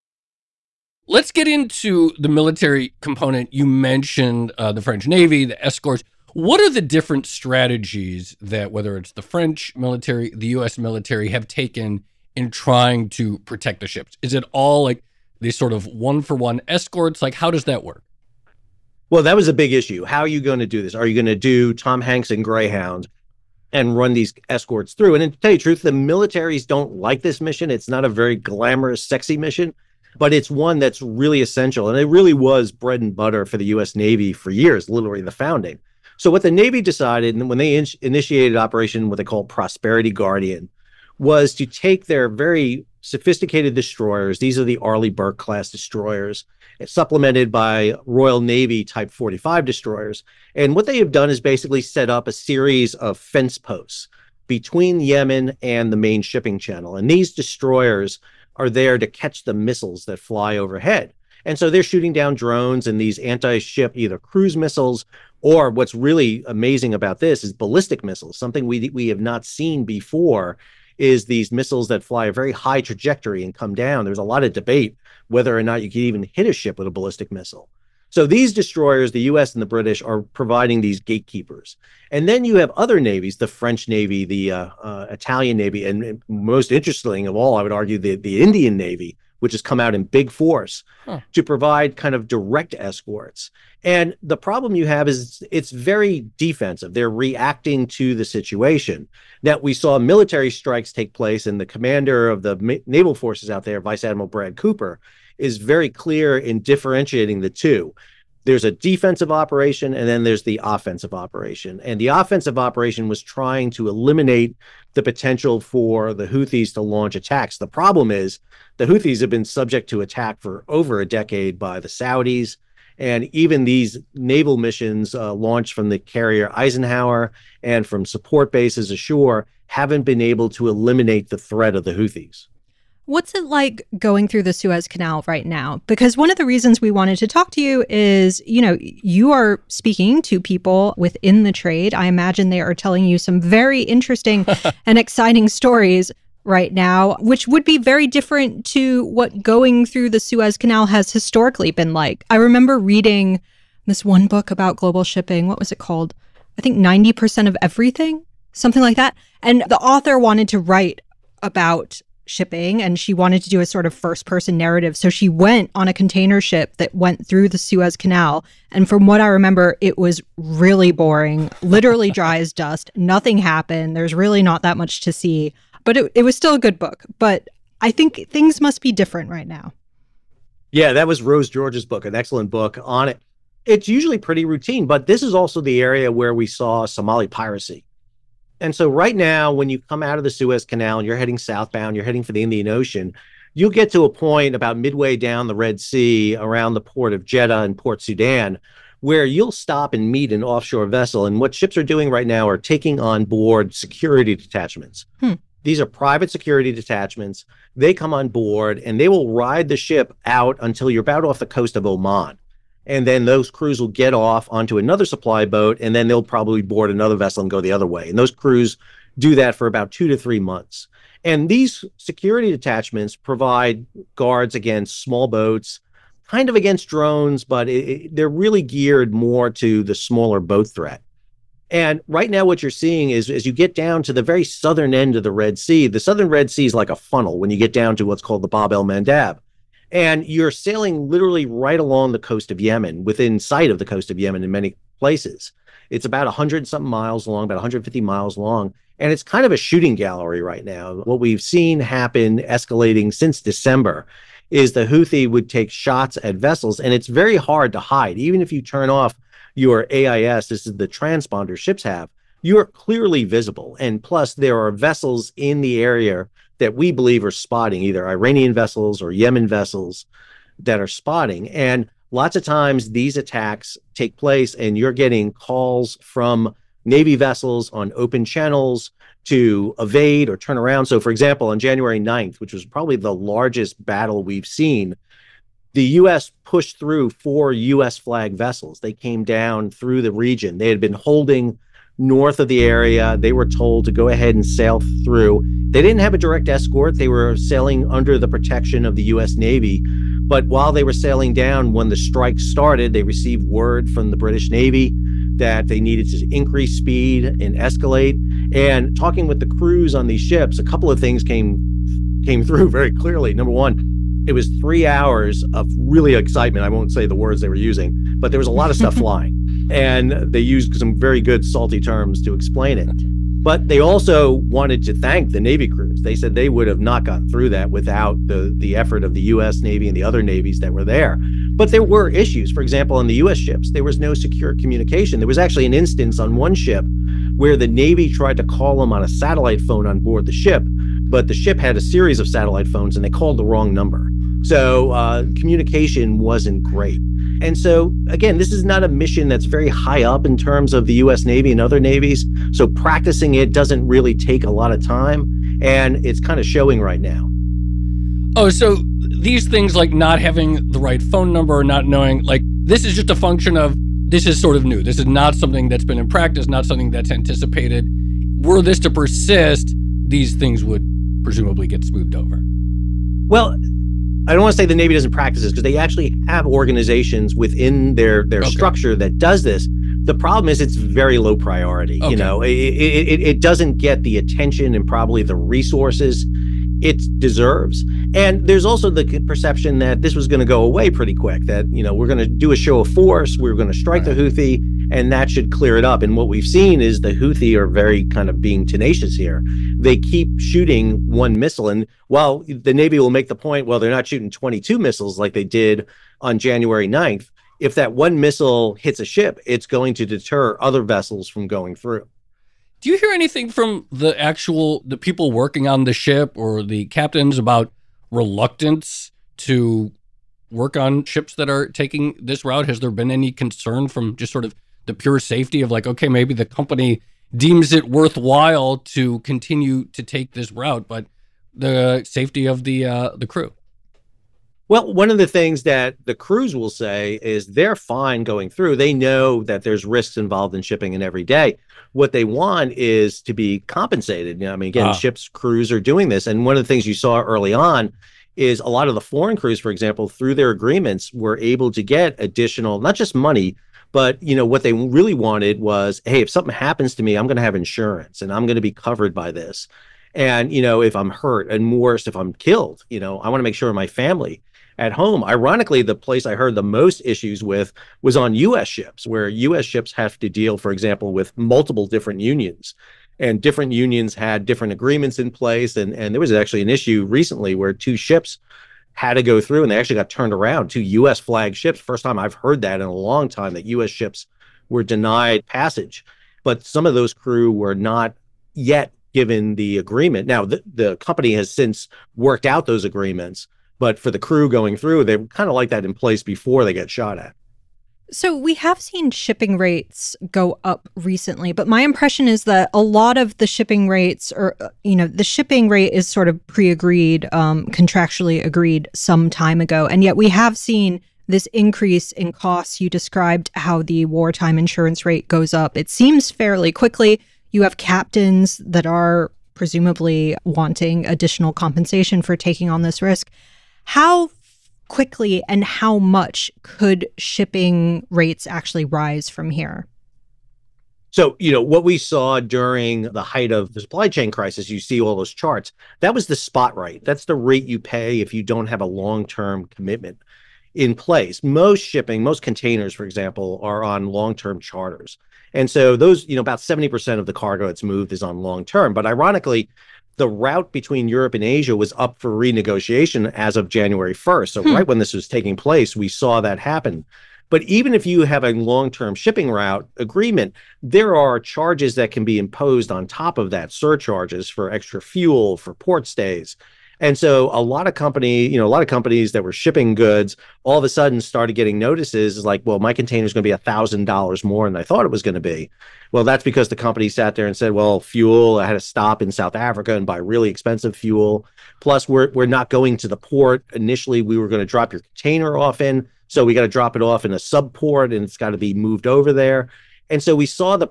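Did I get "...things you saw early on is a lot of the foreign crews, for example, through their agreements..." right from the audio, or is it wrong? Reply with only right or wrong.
right.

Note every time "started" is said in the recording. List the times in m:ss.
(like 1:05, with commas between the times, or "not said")
5:02, 9:31.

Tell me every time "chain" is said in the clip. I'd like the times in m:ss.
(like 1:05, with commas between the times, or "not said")
8:54.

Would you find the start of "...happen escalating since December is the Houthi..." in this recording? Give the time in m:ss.
4:11.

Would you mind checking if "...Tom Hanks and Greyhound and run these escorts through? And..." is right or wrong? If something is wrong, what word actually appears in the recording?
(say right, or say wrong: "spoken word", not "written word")
right.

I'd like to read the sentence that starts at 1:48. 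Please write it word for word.
There's a defensive operation and then there's the offensive operation.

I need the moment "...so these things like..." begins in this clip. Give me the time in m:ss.
5:58.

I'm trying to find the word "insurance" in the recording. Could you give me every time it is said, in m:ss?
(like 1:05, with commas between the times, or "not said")
7:37, 8:34.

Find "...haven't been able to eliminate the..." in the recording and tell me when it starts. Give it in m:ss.
2:09.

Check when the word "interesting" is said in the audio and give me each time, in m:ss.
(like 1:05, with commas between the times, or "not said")
1:26, 2:23.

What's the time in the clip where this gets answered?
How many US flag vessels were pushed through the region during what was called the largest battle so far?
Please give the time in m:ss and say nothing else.
4:47.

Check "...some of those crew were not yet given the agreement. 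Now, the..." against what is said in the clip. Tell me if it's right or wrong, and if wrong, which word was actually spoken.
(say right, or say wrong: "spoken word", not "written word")
right.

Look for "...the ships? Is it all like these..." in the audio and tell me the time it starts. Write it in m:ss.
0:13.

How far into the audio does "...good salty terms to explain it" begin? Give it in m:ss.
5:21.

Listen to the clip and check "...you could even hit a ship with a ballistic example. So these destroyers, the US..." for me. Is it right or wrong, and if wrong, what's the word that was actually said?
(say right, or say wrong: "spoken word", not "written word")
wrong: "missile", not "example".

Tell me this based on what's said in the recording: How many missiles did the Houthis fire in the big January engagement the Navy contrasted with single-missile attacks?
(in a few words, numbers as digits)
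22.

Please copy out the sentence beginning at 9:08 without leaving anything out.
But ironically, the route between Europe and Asia was up for renegotiation as of January 1st.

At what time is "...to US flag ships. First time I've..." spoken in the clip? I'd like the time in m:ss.
8:00.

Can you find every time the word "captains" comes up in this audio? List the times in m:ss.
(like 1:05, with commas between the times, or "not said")
6:56, 8:37.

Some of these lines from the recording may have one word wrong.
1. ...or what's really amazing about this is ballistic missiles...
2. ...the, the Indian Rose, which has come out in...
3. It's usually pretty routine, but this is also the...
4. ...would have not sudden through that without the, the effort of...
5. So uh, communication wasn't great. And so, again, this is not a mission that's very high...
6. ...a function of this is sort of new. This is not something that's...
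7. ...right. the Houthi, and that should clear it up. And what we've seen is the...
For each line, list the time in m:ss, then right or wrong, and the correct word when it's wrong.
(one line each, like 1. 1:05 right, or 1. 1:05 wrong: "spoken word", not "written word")
1. 1:05 right
2. 1:27 wrong: "Navy", not "Rose"
3. 3:03 right
4. 5:26 wrong: "gotten", not "sudden"
5. 5:44 right
6. 6:03 right
7. 6:34 right.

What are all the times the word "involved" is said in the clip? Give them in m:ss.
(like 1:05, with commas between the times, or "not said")
7:20.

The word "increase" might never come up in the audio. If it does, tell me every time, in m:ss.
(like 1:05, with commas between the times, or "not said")
5:06, 8:31.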